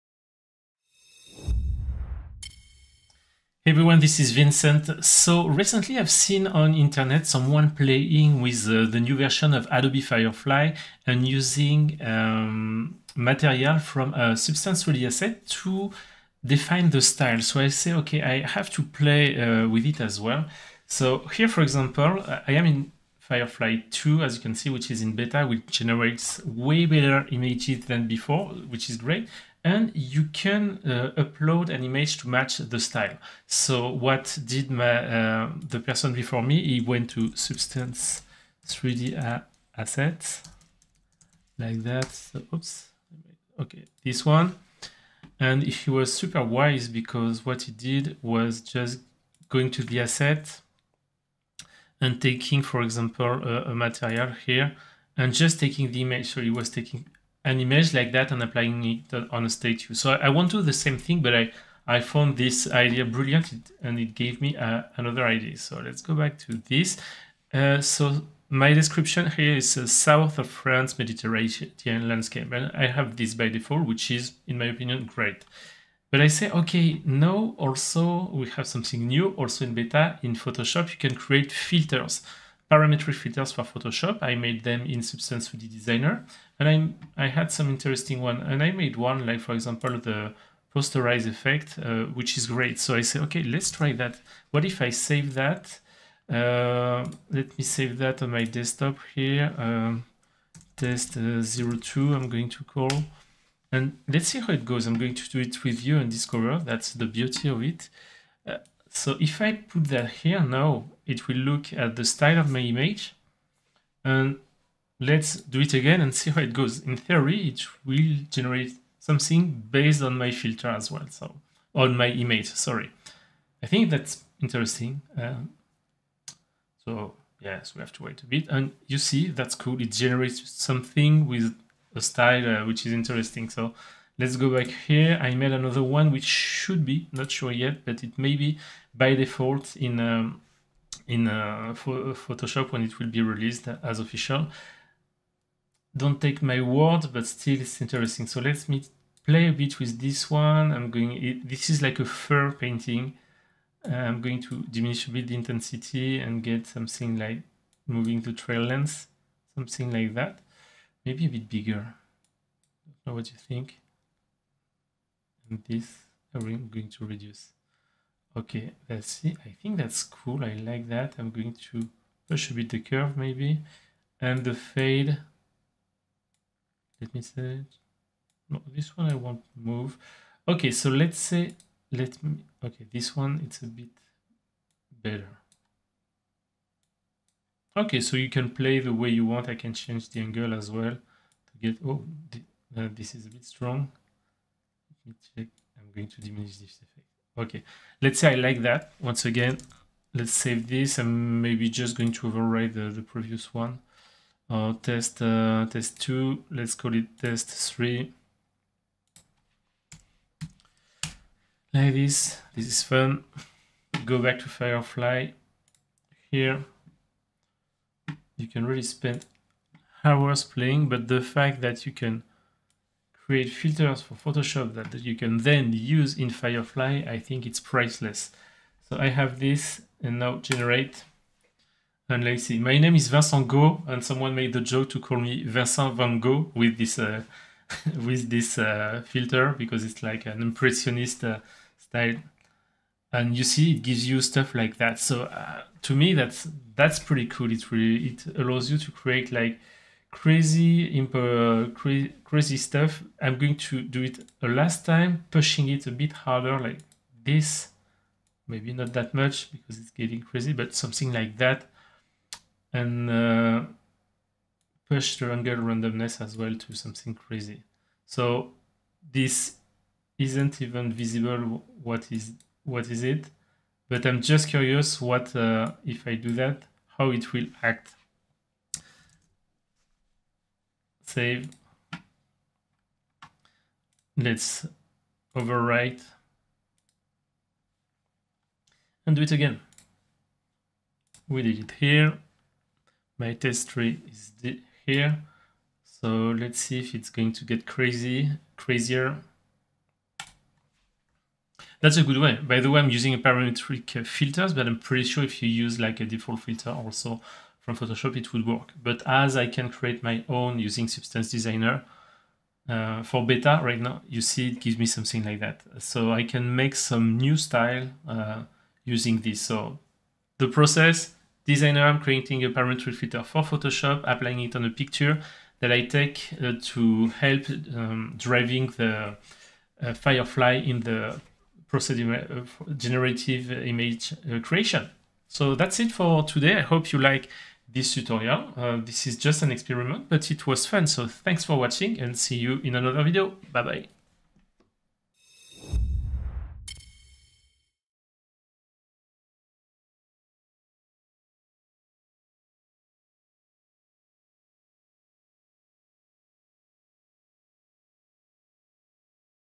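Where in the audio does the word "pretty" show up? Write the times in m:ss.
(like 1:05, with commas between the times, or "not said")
4:06, 5:04.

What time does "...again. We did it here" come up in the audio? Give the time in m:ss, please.
4:49.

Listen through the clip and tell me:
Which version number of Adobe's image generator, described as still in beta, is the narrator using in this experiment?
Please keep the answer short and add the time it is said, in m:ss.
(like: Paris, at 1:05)
Firefly 2, at 0:23.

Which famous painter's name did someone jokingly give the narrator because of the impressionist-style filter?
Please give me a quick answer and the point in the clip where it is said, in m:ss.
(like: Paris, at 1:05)
Vincent Van Gogh, at 3:55.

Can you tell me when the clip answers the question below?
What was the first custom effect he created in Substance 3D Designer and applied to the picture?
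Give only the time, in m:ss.
1:30.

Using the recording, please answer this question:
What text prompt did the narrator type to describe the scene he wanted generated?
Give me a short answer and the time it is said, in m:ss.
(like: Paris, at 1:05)
south of France Mediterranean landscape, at 1:09.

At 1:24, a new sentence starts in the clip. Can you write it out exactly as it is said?
I made them in Substance 3D Designer.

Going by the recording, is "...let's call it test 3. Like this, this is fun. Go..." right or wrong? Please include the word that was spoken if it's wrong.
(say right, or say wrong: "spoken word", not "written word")
right.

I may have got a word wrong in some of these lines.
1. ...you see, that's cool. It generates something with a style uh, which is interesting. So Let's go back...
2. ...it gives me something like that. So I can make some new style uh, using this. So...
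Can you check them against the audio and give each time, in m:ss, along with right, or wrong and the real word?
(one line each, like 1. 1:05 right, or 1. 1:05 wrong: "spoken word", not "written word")
1. 2:08 right
2. 5:14 right.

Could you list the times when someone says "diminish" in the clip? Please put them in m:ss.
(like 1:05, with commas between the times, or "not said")
2:34, 3:16.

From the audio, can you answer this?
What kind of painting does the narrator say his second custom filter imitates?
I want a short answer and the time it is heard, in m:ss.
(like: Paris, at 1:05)
fur painting, at 2:32.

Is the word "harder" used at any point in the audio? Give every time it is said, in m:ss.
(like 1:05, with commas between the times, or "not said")
4:16.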